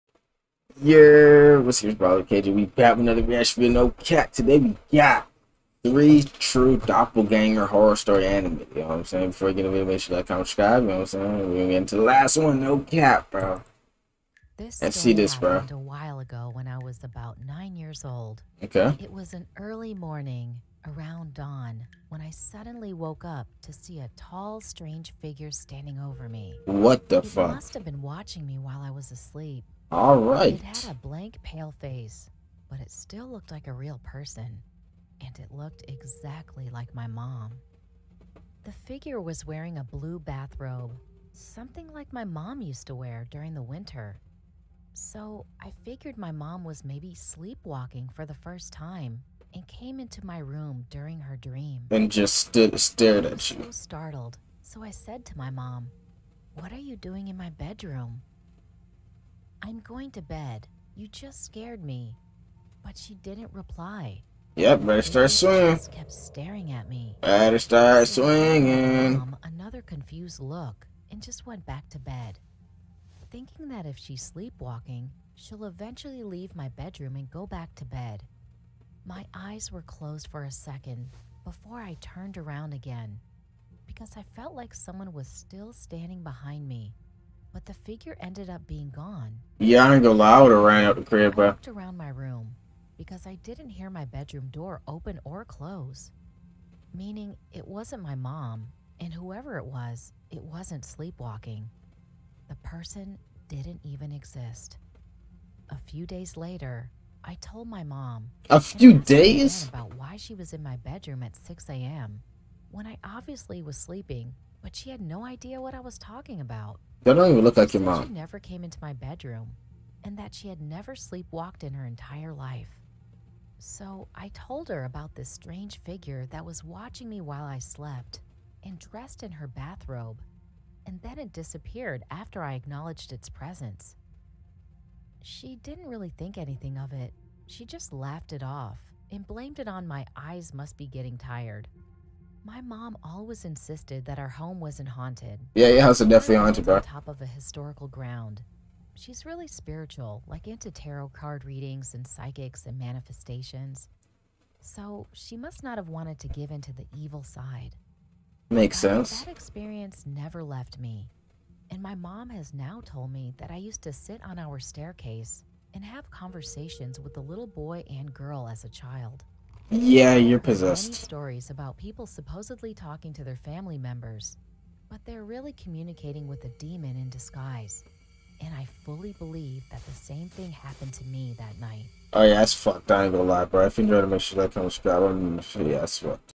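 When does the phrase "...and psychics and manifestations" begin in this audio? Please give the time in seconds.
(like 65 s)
151 s.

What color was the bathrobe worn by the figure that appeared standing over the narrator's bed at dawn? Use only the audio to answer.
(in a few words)
Blue.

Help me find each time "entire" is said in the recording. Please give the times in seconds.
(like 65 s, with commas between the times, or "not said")
121 s.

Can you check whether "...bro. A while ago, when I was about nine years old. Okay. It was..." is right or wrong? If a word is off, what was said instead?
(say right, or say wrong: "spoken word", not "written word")
right.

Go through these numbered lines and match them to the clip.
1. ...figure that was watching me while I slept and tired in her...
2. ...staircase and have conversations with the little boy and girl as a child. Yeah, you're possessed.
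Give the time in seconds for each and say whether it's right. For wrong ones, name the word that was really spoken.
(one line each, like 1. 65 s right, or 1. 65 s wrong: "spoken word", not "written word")
1. 125 s wrong: "dressed", not "tired"
2. 164 s right.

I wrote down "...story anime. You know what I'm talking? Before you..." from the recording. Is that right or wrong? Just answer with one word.
wrong.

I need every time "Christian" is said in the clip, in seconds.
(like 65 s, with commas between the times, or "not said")
not said.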